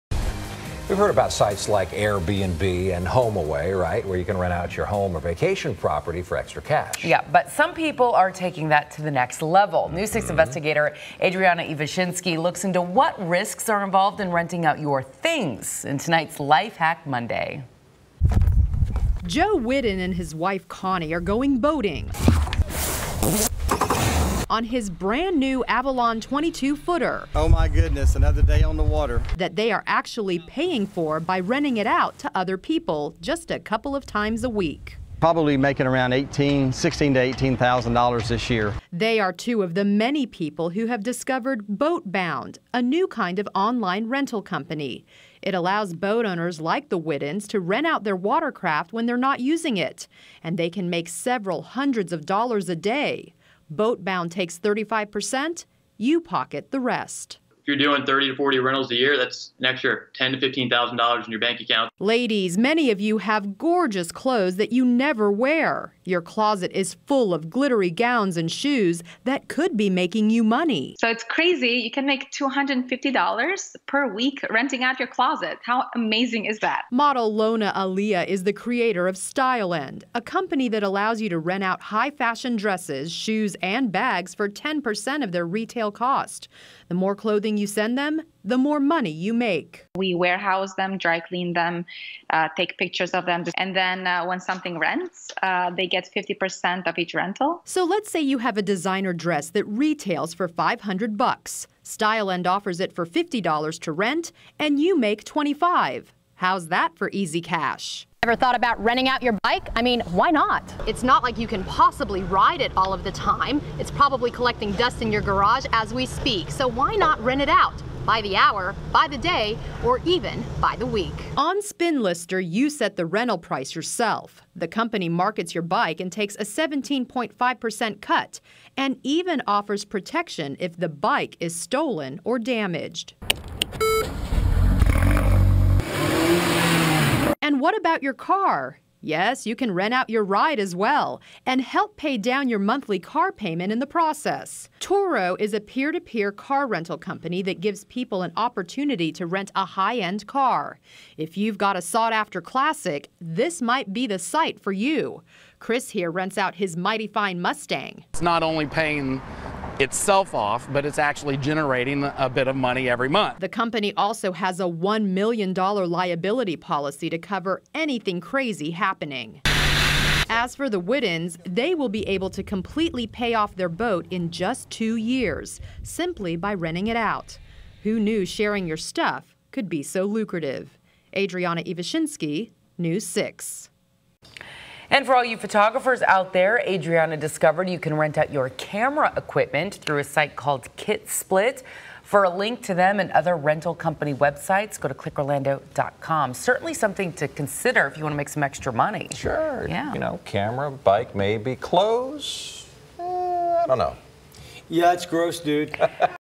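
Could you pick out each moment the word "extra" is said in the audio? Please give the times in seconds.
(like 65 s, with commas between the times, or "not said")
6 s, 59 s, 198 s.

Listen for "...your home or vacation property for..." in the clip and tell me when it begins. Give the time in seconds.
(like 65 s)
4 s.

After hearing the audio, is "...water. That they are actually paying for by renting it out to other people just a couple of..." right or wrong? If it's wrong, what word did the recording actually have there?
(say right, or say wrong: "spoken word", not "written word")
right.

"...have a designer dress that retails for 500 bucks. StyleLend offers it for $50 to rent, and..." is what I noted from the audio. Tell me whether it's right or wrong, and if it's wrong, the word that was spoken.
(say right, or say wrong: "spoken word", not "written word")
right.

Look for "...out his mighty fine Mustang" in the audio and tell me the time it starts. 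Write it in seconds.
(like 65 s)
156 s.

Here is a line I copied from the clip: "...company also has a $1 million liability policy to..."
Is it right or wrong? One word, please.
right.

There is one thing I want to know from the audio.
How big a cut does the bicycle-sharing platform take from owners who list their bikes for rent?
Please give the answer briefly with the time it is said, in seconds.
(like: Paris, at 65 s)
17.5%, at 126 s.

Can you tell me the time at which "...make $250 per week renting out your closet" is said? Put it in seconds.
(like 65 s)
72 s.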